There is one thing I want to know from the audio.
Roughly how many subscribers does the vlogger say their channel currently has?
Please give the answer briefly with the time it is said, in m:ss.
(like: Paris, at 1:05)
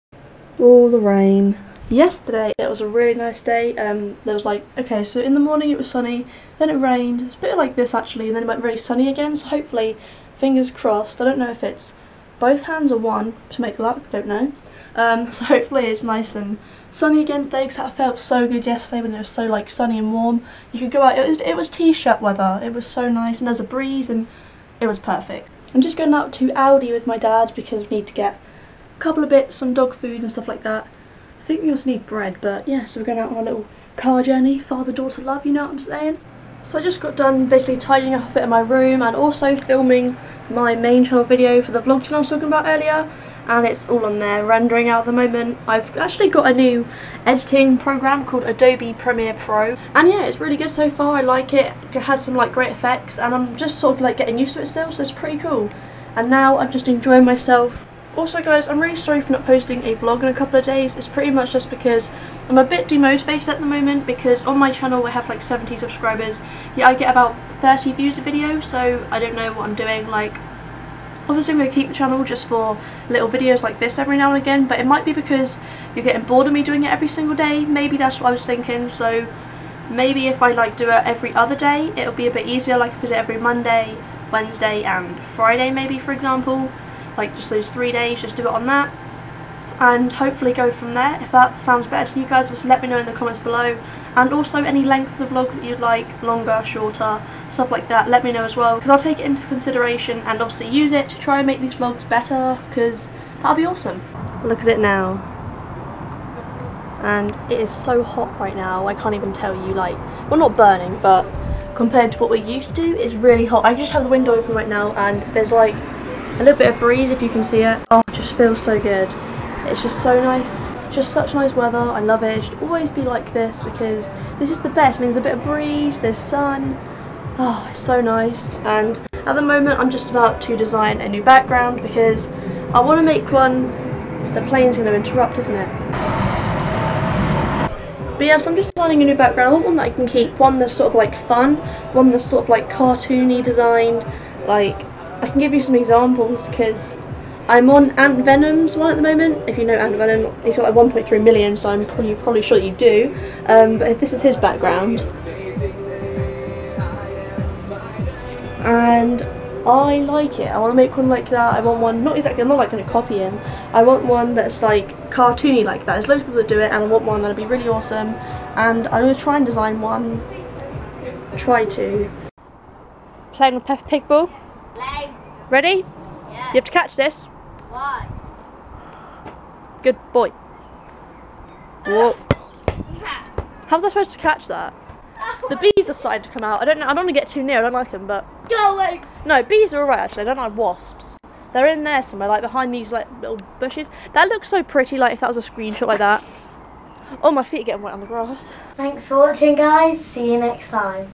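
70, at 1:05.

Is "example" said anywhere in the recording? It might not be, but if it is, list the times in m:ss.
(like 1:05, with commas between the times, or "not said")
1:26, 2:25.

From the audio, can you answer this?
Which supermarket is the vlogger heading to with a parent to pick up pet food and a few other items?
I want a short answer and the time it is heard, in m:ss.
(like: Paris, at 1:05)
Aldi, at 0:26.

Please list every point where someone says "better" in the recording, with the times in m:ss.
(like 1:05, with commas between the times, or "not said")
1:31, 1:42.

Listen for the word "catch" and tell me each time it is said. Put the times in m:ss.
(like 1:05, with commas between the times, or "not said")
2:56, 3:04.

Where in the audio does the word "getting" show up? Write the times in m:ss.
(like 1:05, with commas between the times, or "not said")
0:54, 1:16, 3:17.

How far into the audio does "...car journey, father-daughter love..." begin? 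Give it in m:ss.
0:33.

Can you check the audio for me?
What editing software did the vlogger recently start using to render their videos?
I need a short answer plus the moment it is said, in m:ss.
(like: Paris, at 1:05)
Adobe Premiere Pro, at 0:48.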